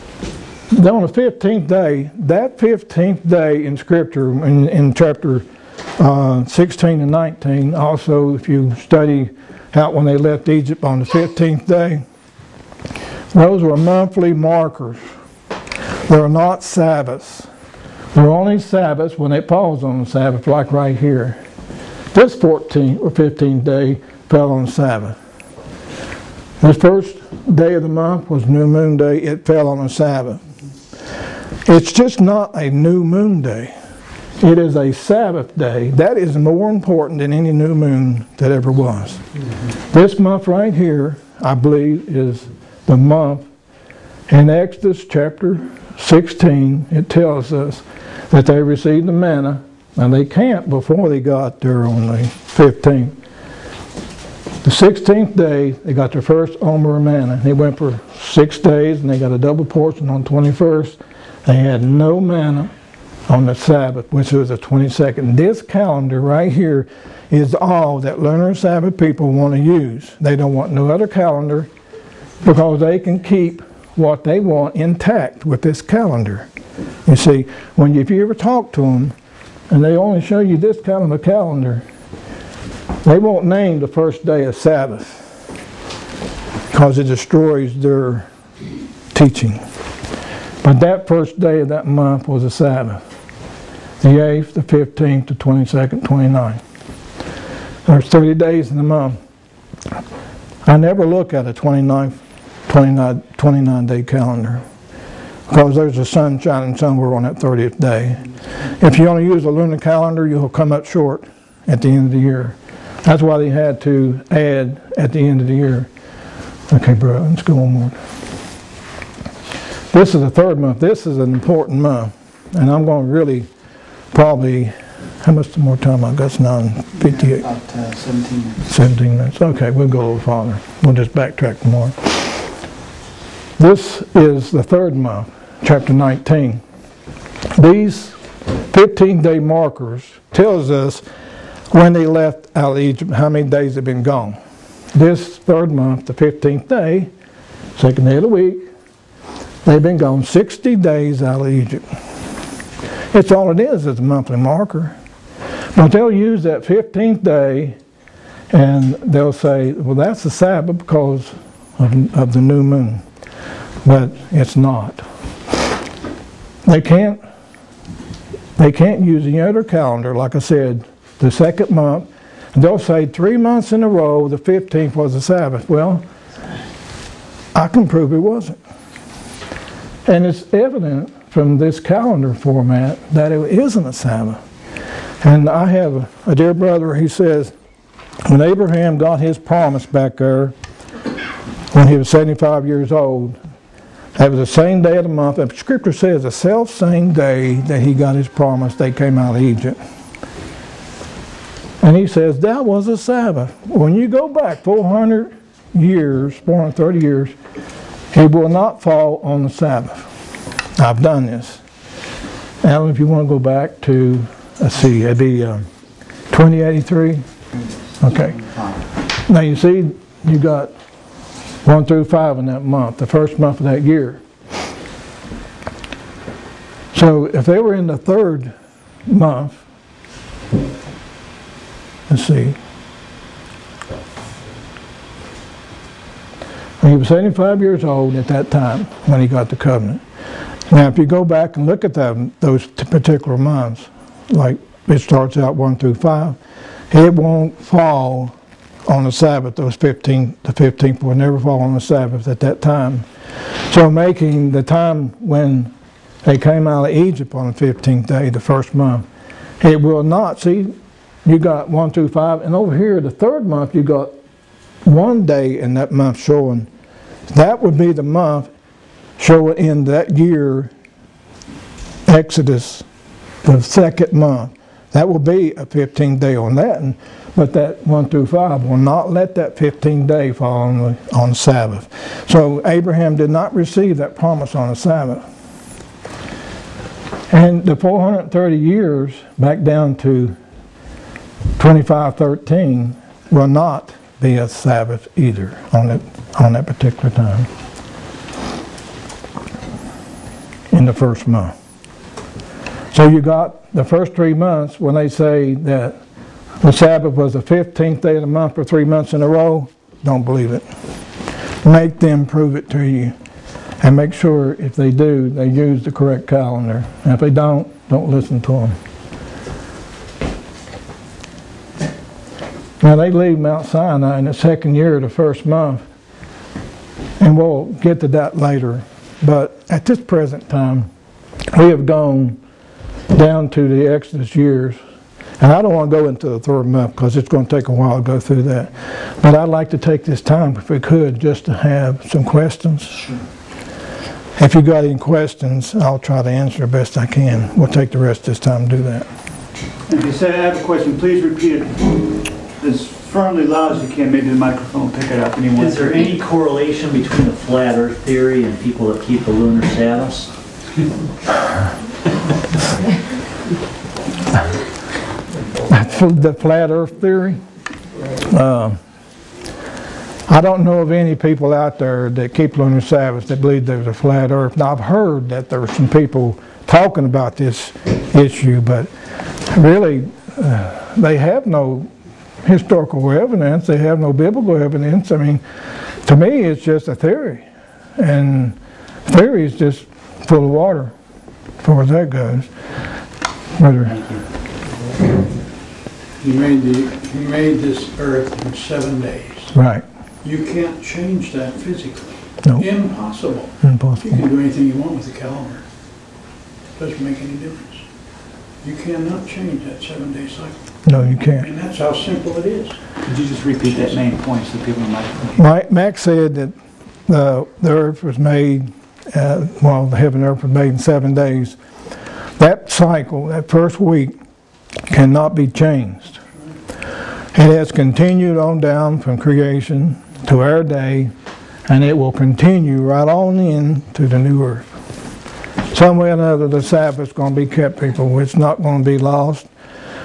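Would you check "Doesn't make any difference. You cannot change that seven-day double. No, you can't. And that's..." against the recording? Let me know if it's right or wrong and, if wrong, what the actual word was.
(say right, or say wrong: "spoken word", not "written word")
wrong: "cycle", not "double".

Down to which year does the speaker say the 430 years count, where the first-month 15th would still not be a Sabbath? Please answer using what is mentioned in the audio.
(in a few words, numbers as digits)
2513.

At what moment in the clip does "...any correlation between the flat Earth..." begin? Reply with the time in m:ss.
5:55.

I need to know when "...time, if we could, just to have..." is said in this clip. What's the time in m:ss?
5:40.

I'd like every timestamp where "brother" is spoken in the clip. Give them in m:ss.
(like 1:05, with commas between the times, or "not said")
3:06.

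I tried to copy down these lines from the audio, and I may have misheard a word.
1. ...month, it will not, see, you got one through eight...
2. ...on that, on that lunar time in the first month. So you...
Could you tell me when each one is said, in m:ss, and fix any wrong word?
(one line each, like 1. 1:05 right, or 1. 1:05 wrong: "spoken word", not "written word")
1. 4:18 wrong: "five", not "eight"
2. 4:55 wrong: "particular", not "lunar".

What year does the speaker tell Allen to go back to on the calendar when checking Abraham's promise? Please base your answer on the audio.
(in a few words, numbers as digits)
2083.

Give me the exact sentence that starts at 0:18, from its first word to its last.
They're only Sabbaths when they pause on the Sabbath, like right here.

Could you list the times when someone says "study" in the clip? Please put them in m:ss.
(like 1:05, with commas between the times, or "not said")
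0:08.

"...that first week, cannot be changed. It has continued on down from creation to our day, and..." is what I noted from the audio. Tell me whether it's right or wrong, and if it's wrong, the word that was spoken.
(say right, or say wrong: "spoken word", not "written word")
right.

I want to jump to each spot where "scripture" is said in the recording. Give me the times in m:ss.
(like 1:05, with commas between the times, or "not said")
0:03, 3:15.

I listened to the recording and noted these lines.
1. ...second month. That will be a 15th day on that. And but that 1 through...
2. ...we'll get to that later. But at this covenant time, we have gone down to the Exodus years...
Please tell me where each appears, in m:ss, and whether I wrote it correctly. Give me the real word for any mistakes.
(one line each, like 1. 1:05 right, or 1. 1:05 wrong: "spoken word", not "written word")
1. 4:33 right
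2. 5:27 wrong: "present", not "covenant".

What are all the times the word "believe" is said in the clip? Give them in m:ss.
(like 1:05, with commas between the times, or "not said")
0:41, 5:10, 6:13.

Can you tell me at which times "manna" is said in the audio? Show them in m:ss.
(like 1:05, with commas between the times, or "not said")
0:49, 0:57, 1:02.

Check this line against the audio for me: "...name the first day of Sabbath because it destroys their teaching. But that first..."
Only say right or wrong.
right.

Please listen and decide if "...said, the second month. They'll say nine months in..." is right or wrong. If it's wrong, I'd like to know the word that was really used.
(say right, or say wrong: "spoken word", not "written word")
wrong: "three", not "nine".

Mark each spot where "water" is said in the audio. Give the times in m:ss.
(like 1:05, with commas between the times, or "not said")
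6:30.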